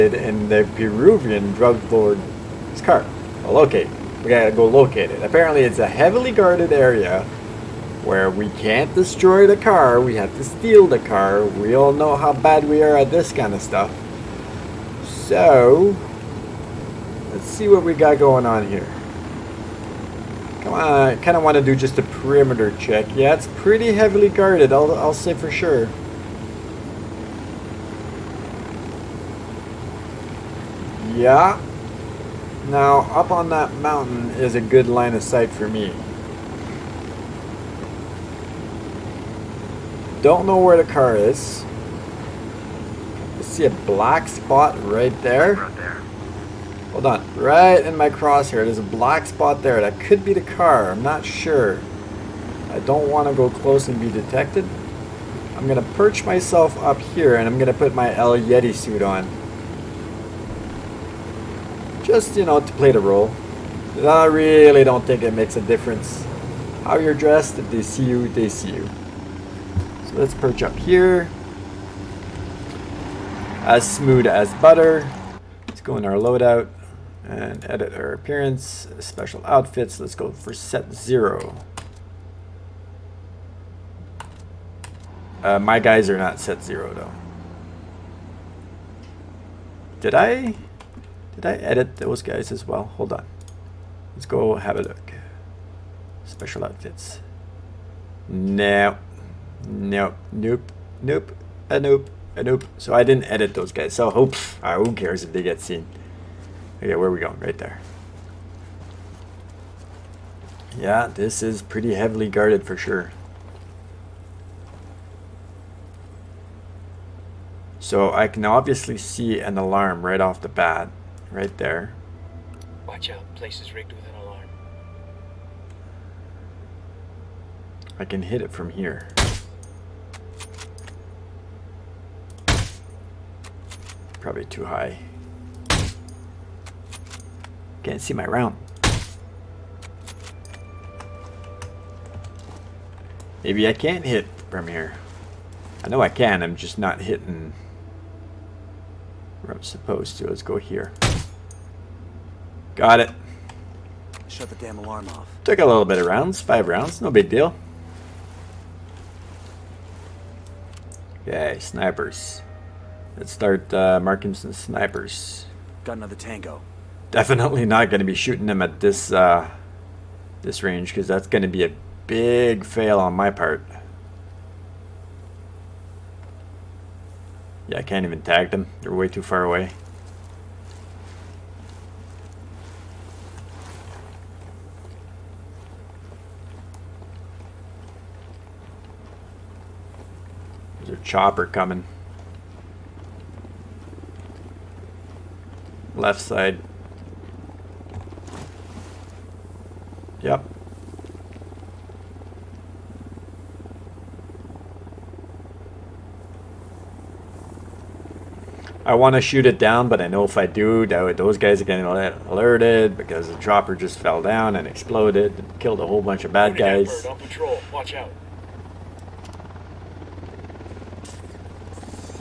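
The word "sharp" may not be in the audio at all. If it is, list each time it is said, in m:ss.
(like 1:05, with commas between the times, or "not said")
not said.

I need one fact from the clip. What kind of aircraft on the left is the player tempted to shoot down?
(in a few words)
Chopper.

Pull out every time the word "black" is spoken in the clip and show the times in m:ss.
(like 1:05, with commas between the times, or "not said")
0:43, 0:48.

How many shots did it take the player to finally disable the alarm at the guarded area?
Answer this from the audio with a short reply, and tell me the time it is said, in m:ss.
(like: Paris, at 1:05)
5, at 2:36.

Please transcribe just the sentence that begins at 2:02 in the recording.
Watch out, place is rigged with an alarm.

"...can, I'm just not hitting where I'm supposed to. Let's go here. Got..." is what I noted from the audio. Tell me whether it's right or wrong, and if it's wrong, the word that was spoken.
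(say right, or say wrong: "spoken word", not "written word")
right.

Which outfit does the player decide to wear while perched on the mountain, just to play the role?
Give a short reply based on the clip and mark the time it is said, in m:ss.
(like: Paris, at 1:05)
El Yeti suit, at 0:58.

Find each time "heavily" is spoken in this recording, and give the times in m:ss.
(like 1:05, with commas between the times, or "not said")
0:05, 0:23, 1:51.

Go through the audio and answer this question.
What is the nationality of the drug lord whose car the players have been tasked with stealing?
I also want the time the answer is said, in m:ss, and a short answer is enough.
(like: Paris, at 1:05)
Peruvian, at 0:00.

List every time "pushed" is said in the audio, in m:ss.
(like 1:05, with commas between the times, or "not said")
not said.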